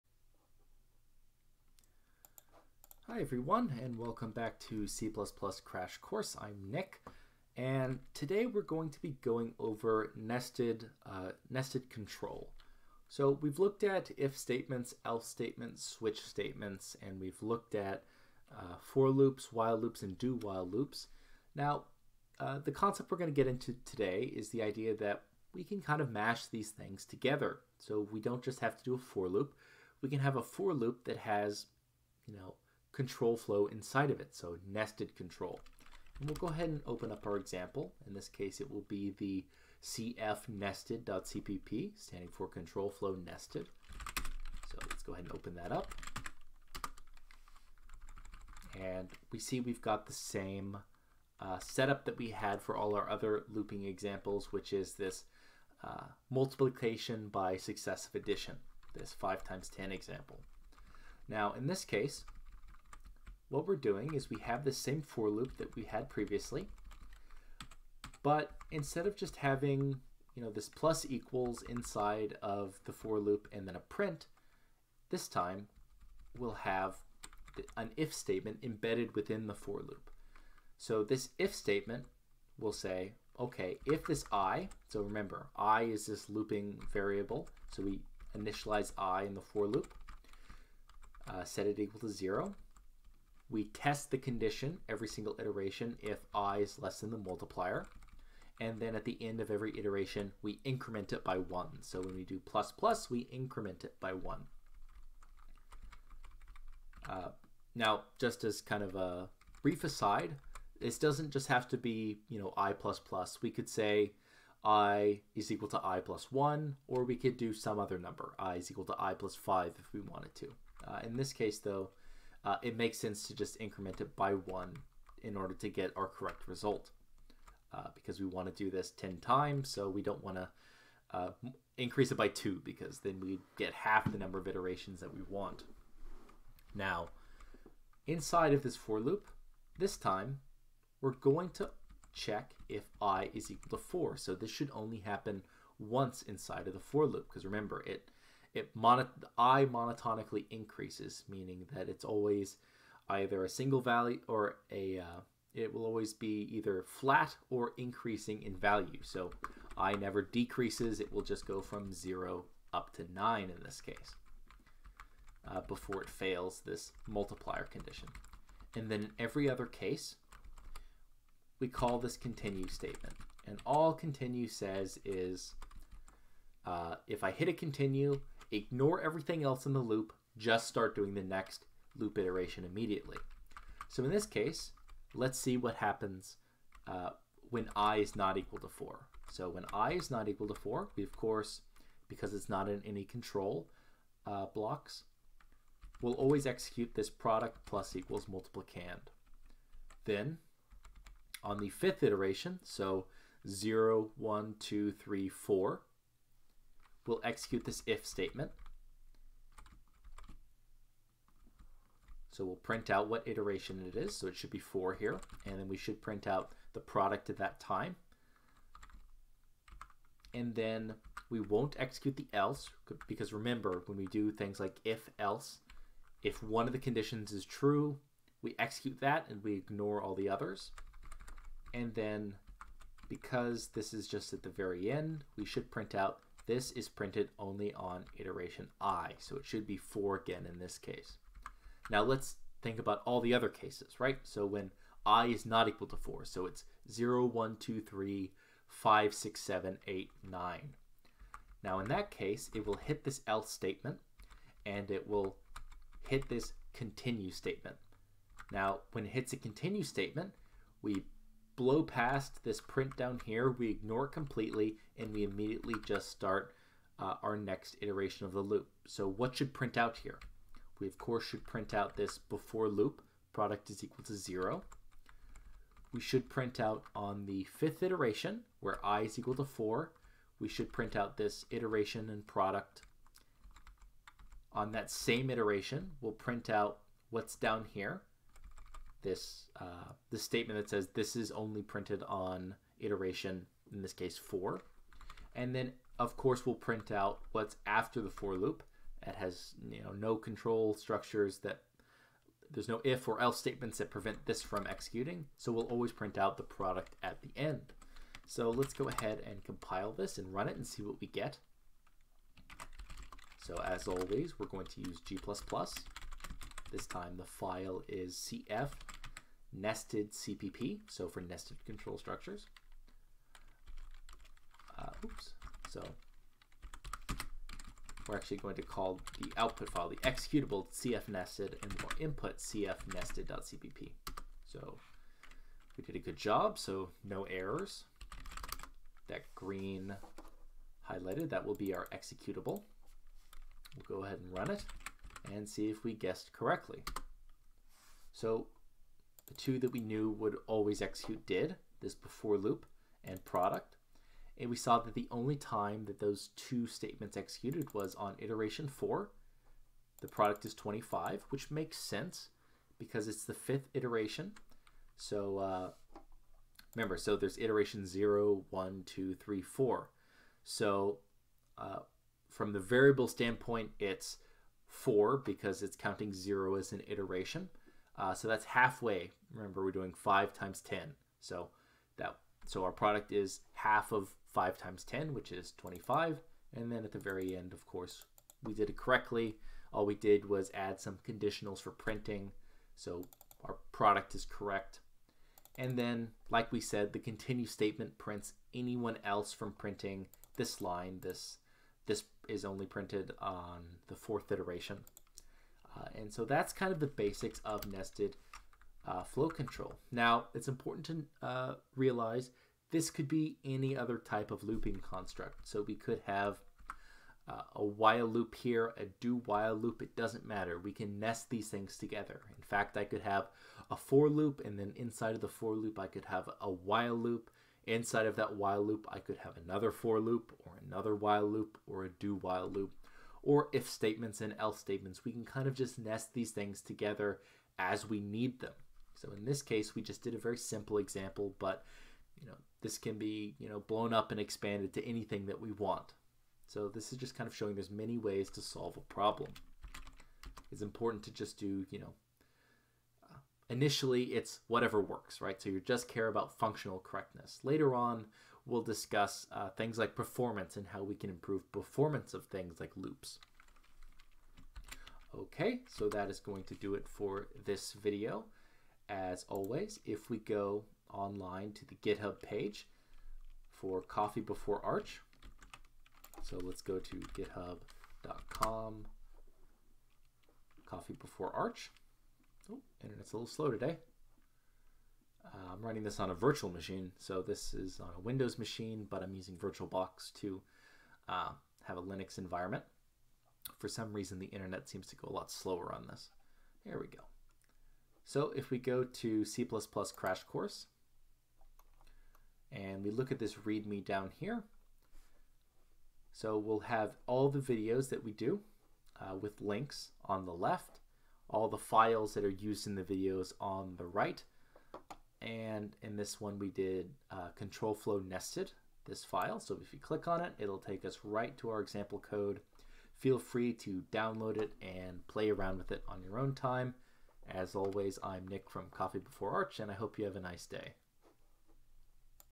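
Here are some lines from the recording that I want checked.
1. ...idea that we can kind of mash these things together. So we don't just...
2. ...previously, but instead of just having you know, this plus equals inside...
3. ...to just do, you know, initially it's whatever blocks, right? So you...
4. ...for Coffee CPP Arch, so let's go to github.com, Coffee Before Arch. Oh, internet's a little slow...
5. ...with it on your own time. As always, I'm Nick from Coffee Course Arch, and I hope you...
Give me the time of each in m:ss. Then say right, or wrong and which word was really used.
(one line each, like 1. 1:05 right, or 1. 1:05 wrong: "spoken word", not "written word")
1. 0:24 right
2. 1:06 right
3. 7:31 wrong: "works", not "blocks"
4. 7:53 wrong: "Before", not "CPP"
5. 8:45 wrong: "Before", not "Course".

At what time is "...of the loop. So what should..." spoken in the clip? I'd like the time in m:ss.
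4:28.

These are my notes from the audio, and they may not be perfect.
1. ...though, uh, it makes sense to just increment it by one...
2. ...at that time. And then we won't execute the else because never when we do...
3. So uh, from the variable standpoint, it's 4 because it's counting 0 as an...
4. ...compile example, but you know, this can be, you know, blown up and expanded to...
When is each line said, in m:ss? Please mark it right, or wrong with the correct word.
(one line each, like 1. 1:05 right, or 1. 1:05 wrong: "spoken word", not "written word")
1. 2:01 right
2. 3:37 wrong: "remember", not "never"
3. 6:10 right
4. 7:20 wrong: "simple", not "compile".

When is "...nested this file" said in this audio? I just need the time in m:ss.
8:37.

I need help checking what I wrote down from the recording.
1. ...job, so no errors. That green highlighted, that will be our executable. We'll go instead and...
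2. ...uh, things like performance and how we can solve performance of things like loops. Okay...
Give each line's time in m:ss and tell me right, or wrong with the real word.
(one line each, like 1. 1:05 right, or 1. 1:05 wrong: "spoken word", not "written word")
1. 5:36 wrong: "ahead", not "instead"
2. 7:39 wrong: "improve", not "solve".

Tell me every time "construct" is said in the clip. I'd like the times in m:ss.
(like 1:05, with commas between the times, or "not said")
6:54.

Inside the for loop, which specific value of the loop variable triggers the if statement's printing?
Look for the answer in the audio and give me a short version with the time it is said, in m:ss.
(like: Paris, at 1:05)
4, at 2:22.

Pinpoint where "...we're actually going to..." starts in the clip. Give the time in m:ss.
5:28.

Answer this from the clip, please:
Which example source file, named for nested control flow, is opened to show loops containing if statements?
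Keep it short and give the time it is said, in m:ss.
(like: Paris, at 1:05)
cfnested.cpp, at 0:39.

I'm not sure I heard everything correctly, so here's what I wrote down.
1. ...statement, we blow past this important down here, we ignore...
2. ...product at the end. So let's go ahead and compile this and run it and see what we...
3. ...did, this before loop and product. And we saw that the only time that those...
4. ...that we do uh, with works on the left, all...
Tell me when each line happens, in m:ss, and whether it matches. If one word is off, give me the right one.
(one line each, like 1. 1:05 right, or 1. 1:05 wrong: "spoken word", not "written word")
1. 4:19 wrong: "print", not "important"
2. 5:06 right
3. 5:51 right
4. 8:27 wrong: "links", not "works".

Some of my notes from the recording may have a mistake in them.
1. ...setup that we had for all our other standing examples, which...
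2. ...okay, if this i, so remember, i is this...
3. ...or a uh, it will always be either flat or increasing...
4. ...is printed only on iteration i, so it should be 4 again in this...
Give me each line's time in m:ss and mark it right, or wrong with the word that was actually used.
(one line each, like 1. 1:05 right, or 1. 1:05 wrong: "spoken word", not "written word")
1. 0:51 wrong: "looping", not "standing"
2. 1:23 right
3. 2:34 right
4. 3:56 right.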